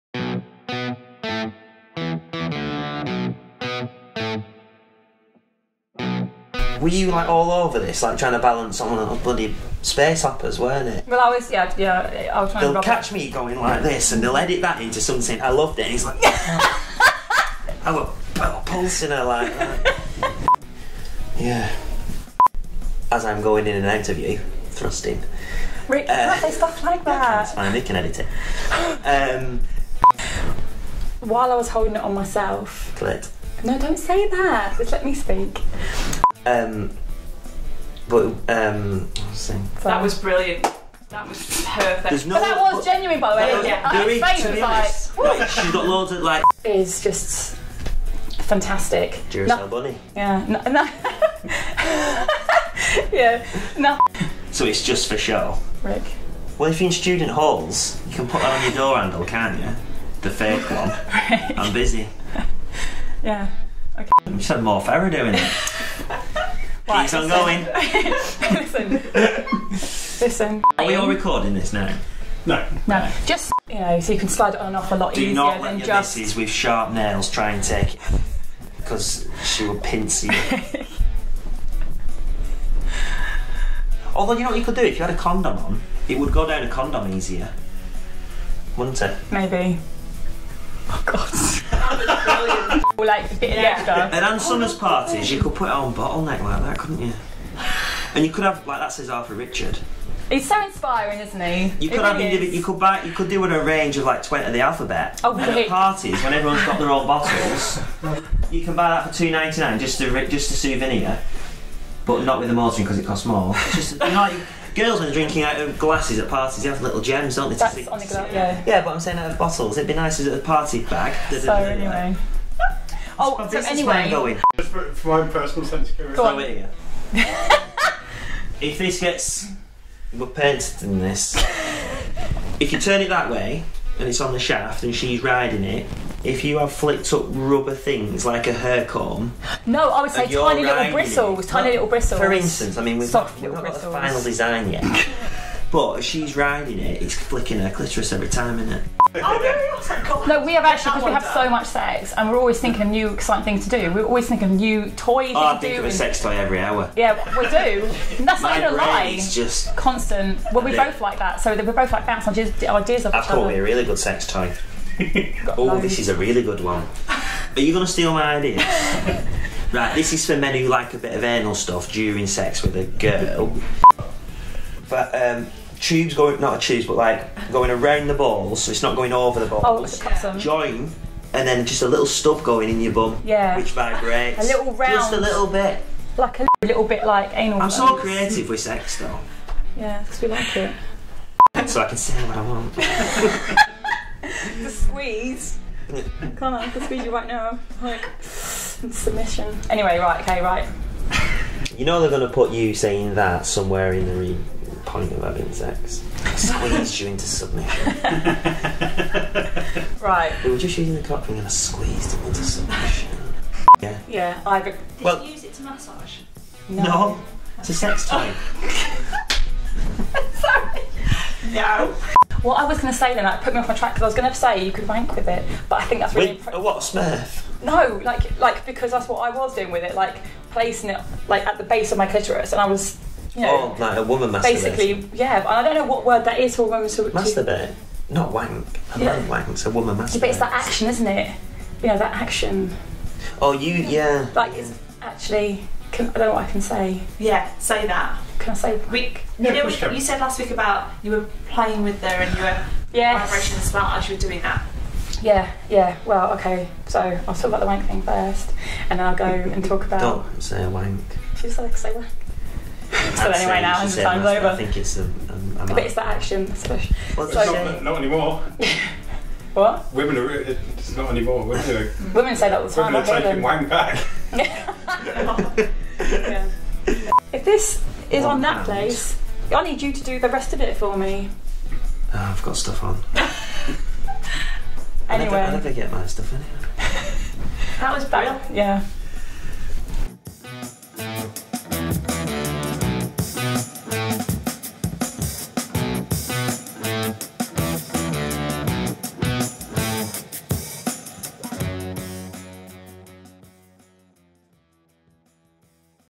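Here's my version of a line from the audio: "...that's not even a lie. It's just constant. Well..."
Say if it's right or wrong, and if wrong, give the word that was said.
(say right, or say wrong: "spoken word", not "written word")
right.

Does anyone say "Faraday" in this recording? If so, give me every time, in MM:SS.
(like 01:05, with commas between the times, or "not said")
01:04.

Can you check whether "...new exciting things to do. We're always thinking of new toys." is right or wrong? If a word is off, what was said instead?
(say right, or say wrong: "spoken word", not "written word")
right.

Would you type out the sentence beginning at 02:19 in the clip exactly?
No, I would say tiny little bristles, tiny little bristles.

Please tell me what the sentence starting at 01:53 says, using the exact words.
It's just you know, girls are drinking out uh, of glasses at parties, they have little gems, don't they?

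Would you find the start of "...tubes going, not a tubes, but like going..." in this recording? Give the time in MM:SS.
02:55.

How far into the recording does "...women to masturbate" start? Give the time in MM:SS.
03:56.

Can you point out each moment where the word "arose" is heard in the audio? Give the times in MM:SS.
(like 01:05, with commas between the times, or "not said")
not said.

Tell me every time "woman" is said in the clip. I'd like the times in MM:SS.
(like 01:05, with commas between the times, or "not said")
03:54, 03:59.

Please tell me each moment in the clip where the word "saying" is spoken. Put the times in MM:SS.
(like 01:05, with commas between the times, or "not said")
01:58, 03:22.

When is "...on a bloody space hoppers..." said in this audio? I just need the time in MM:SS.
00:08.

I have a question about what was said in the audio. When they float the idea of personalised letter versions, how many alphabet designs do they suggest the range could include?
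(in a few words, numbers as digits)
20.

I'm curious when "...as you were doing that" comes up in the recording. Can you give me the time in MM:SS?
04:13.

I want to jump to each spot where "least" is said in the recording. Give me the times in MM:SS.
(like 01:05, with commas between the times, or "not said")
not said.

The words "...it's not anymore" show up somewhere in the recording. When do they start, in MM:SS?
04:30.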